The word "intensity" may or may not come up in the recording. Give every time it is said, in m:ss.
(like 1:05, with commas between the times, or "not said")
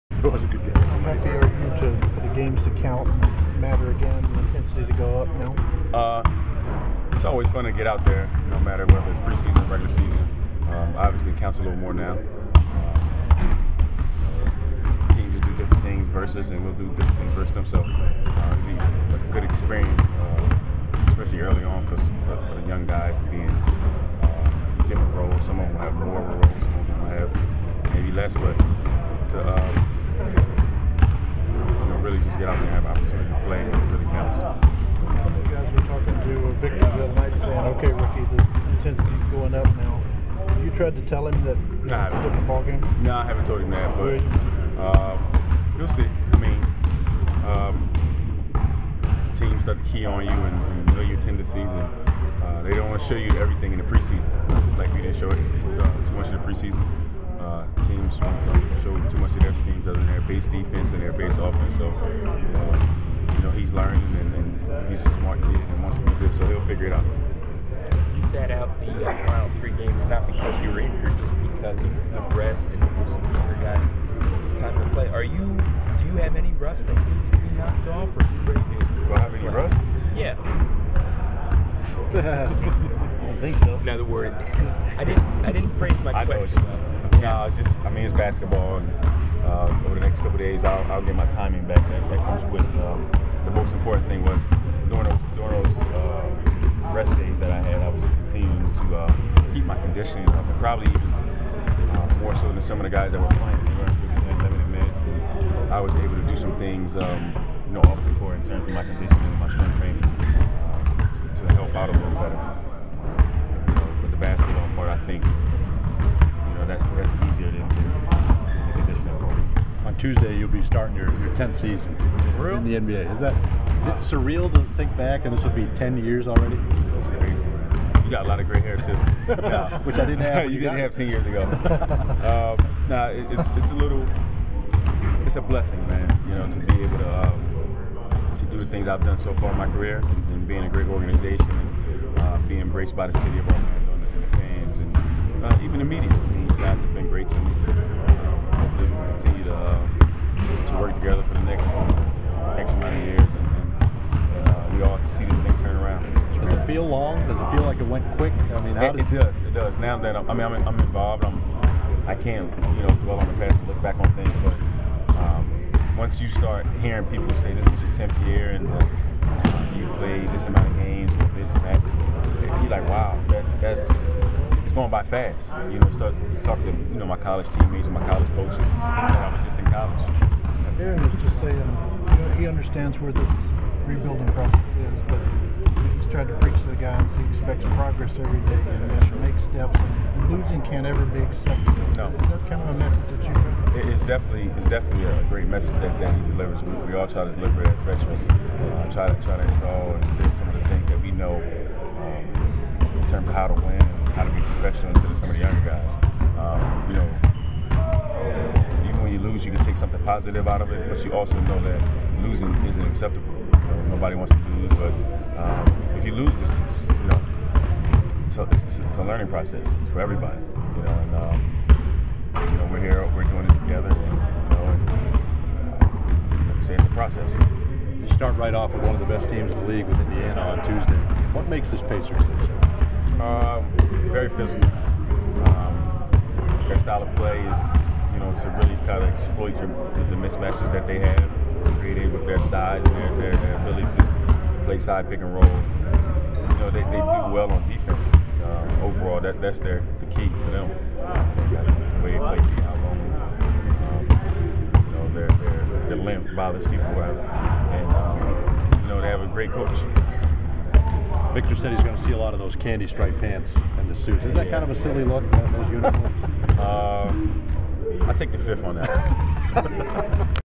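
0:04, 0:38.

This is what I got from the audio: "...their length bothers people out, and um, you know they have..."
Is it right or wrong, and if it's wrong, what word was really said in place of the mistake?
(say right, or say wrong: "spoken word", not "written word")
right.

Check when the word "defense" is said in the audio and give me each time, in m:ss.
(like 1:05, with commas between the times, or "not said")
1:00, 4:07.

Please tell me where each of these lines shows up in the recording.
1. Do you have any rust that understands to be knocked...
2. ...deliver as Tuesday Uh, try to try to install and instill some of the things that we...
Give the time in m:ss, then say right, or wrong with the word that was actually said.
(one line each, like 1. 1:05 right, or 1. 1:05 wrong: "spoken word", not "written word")
1. 1:16 wrong: "needs", not "understands"
2. 3:17 wrong: "Freshmen", not "Tuesday".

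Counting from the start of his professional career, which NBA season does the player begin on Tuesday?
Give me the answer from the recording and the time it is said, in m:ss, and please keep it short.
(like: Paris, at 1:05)
10th, at 2:01.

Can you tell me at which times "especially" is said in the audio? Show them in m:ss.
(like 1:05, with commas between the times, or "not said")
0:21.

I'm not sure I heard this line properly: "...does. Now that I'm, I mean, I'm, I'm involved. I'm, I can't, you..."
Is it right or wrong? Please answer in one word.
right.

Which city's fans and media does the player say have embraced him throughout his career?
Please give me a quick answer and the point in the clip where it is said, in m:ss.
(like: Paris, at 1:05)
Orlando, at 2:23.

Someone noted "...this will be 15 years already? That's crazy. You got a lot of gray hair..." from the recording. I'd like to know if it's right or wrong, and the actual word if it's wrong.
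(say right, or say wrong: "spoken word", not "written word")
wrong: "10", not "15".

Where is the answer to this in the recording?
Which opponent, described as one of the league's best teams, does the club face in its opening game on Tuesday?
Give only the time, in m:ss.
3:50.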